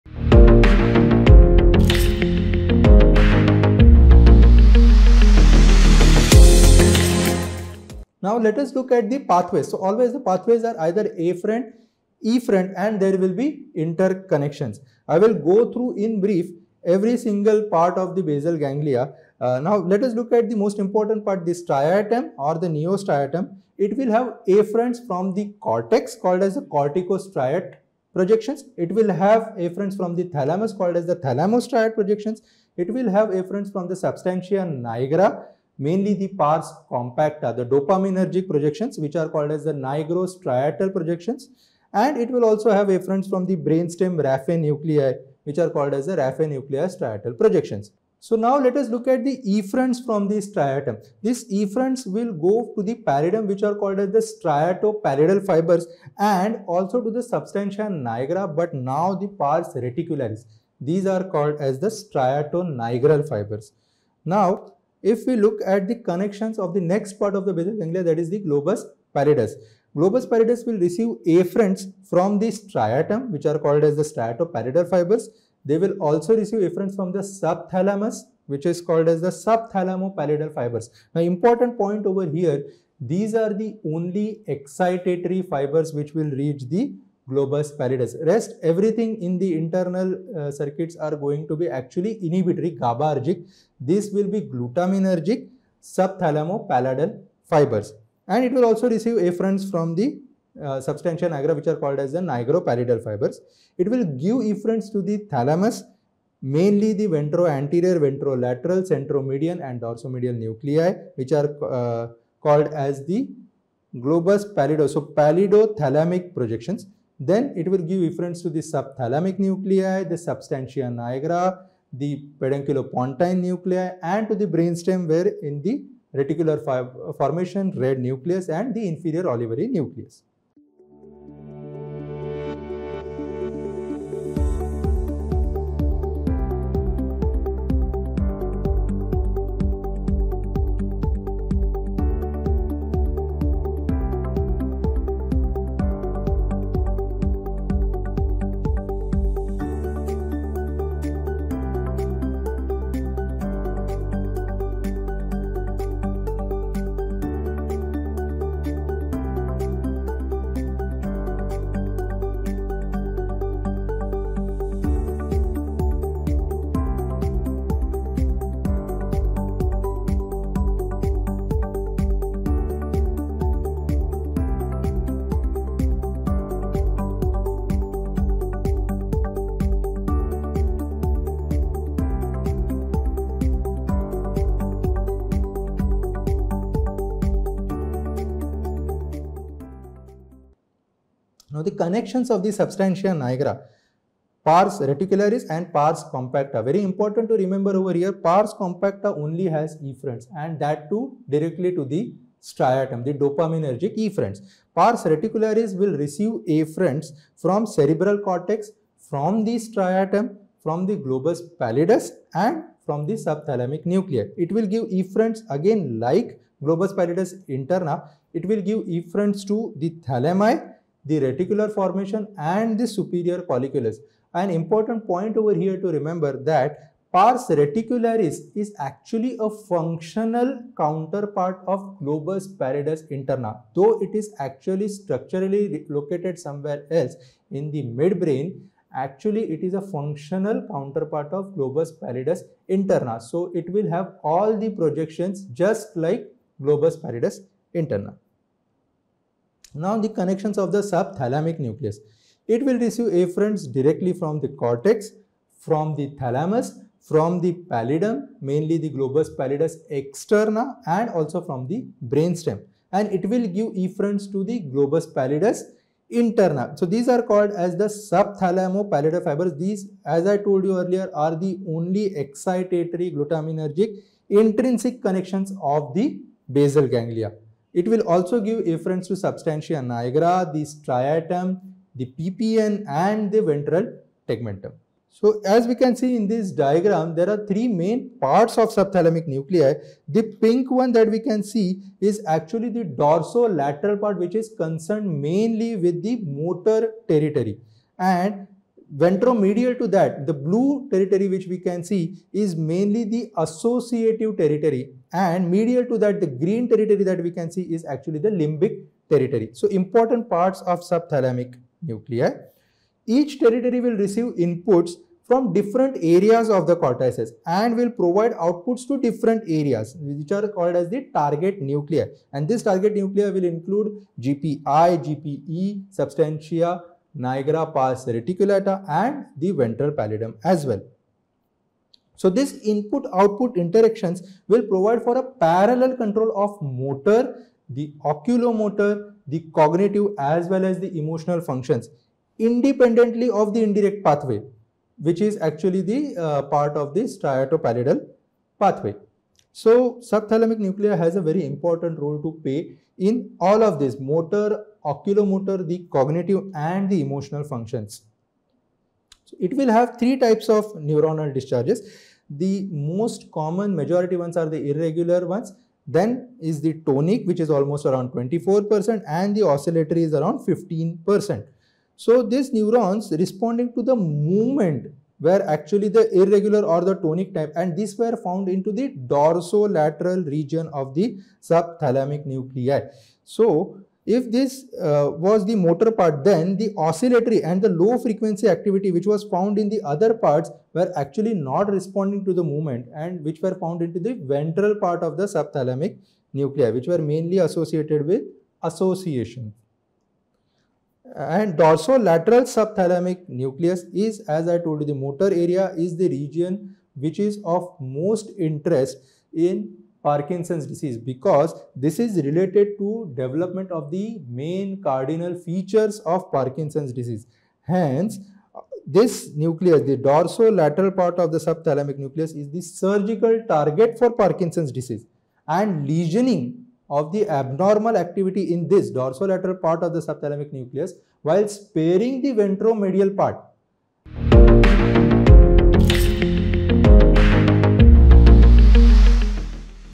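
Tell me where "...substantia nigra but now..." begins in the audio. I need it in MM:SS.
00:57.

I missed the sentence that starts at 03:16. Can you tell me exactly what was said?
Very important to remember over here, pars compacta only has efferents and that too directly to the striatum, the dopaminergic efferents.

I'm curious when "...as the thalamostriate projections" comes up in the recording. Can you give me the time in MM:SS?
00:30.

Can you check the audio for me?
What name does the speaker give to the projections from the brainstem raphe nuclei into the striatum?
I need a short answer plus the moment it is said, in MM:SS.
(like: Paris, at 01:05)
raphe nuclei striatal projections, at 00:46.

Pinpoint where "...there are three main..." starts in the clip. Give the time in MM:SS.
04:47.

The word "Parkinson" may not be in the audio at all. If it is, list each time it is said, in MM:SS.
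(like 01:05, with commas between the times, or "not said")
06:50, 06:56, 07:04.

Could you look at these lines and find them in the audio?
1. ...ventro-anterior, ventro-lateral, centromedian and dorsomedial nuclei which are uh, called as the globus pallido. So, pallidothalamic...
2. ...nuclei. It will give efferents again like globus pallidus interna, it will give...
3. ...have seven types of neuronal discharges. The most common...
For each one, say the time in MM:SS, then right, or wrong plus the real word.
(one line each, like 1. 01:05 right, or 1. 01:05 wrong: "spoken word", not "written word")
1. 01:47 right
2. 03:33 right
3. 05:59 wrong: "three", not "seven".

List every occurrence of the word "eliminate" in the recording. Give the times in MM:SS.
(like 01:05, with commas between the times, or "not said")
not said.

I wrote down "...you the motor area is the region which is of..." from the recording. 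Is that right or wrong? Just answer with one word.
right.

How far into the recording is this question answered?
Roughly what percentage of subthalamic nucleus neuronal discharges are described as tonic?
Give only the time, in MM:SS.
06:08.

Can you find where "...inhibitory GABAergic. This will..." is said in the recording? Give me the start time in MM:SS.
01:32.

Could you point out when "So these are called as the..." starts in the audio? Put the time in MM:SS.
04:26.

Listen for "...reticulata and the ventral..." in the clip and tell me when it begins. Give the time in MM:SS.
05:28.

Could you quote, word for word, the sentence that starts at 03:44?
An important point over here to remember that pars reticularis is actually a functional counterpart of globus pallidus interna.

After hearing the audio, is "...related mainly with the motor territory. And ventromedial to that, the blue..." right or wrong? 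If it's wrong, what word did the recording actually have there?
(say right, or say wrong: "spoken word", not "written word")
wrong: "concerned", not "related".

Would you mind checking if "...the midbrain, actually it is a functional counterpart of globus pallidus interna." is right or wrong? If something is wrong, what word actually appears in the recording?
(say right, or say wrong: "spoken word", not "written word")
right.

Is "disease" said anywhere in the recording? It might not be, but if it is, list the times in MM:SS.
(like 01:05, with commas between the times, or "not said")
06:50, 06:56, 07:04.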